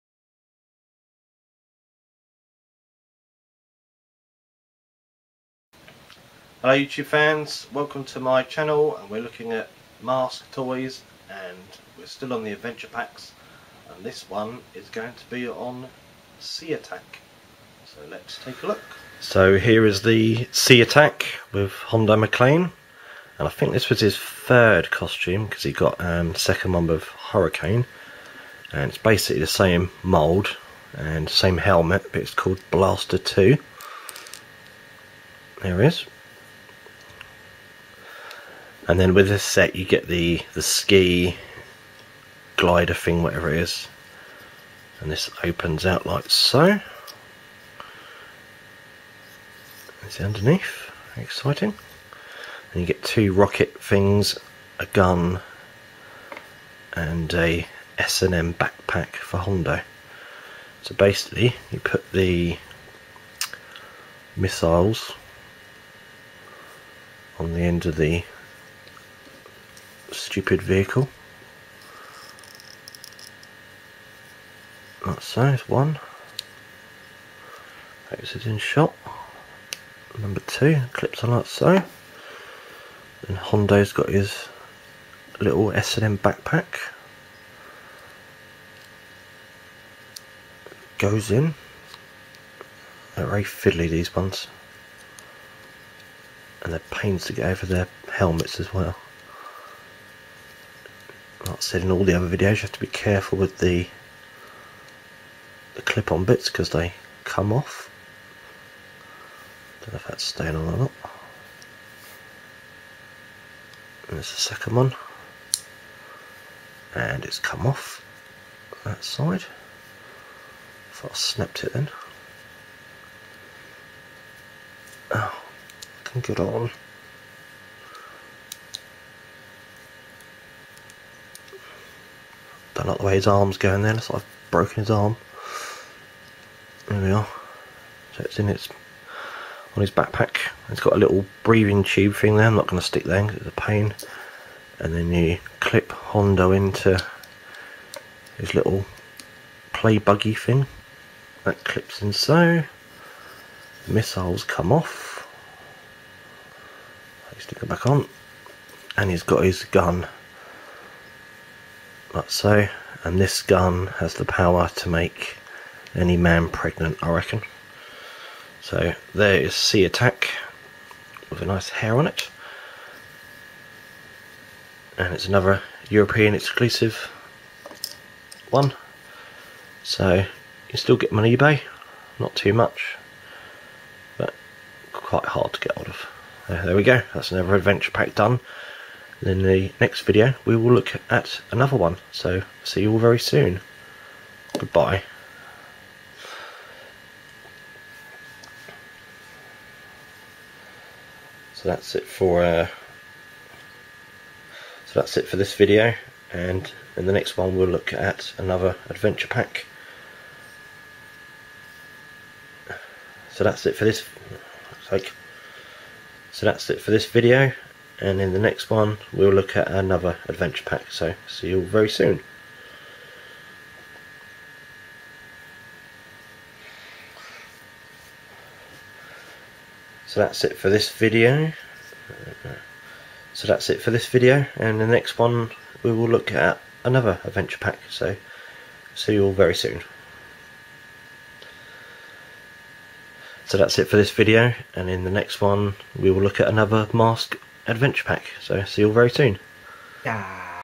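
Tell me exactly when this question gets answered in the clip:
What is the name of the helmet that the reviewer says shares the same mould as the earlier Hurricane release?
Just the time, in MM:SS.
00:32.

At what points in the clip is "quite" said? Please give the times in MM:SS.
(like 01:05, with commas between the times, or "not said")
03:04.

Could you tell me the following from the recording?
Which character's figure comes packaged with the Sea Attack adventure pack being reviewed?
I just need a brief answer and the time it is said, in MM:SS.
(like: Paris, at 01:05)
Hondo MacLean, at 00:21.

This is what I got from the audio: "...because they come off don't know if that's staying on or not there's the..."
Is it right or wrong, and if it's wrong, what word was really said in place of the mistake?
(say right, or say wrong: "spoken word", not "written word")
right.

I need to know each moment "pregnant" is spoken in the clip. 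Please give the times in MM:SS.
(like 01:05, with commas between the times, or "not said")
02:46.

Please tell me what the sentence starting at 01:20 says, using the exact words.
Number two, clips on that side.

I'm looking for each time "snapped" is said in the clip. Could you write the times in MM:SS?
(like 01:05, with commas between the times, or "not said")
02:01.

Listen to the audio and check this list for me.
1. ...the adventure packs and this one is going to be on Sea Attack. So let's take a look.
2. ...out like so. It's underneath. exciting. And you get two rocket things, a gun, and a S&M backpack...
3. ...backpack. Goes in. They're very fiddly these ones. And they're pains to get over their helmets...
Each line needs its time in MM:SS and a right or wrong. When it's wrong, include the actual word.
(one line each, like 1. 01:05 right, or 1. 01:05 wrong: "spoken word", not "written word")
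1. 00:12 right
2. 00:45 right
3. 01:26 right.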